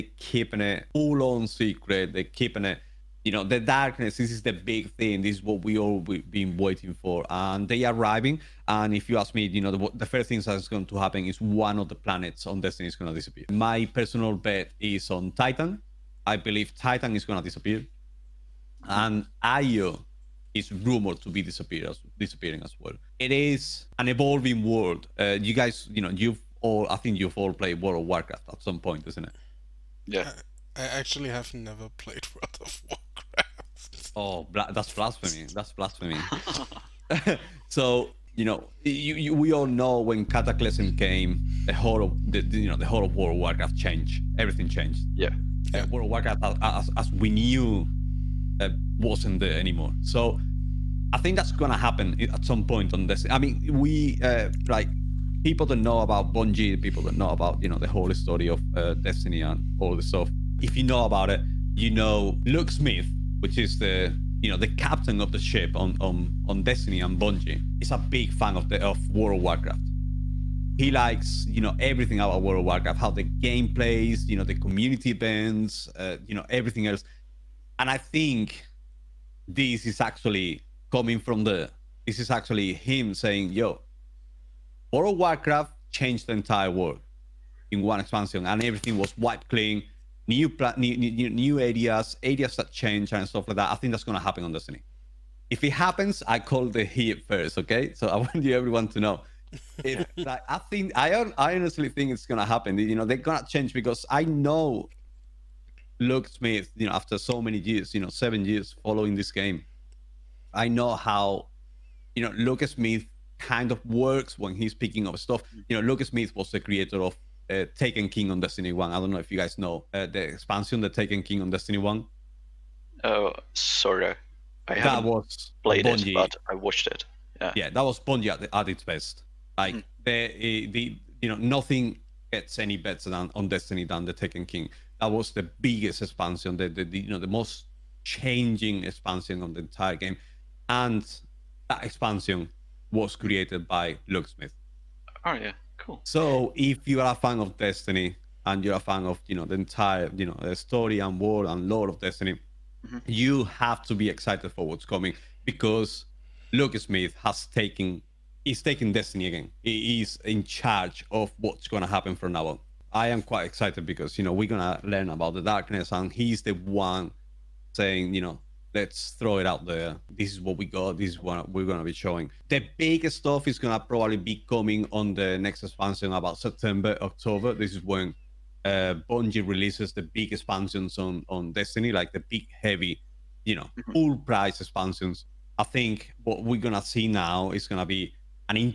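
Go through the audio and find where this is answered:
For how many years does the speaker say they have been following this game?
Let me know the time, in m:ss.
1:48.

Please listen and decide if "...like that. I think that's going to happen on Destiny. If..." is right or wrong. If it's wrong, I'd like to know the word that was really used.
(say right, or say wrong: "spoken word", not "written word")
right.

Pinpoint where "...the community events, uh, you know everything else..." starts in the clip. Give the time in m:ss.
1:14.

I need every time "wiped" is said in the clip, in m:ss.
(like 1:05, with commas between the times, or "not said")
1:29.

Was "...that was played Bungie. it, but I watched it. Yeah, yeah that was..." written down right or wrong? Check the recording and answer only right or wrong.
right.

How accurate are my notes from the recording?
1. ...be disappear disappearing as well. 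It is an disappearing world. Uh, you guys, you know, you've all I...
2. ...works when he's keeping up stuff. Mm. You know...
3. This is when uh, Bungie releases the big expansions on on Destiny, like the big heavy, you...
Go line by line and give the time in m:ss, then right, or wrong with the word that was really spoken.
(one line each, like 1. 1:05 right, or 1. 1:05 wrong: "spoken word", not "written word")
1. 0:21 wrong: "evolving", not "disappearing"
2. 1:53 wrong: "picking", not "keeping"
3. 2:57 right.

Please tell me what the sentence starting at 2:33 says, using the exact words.
you have to be excited for what's coming because Smith has taken is taking Destiny again.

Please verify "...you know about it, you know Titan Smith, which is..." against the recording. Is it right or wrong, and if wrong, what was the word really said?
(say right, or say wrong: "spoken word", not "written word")
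wrong: "Luke", not "Titan".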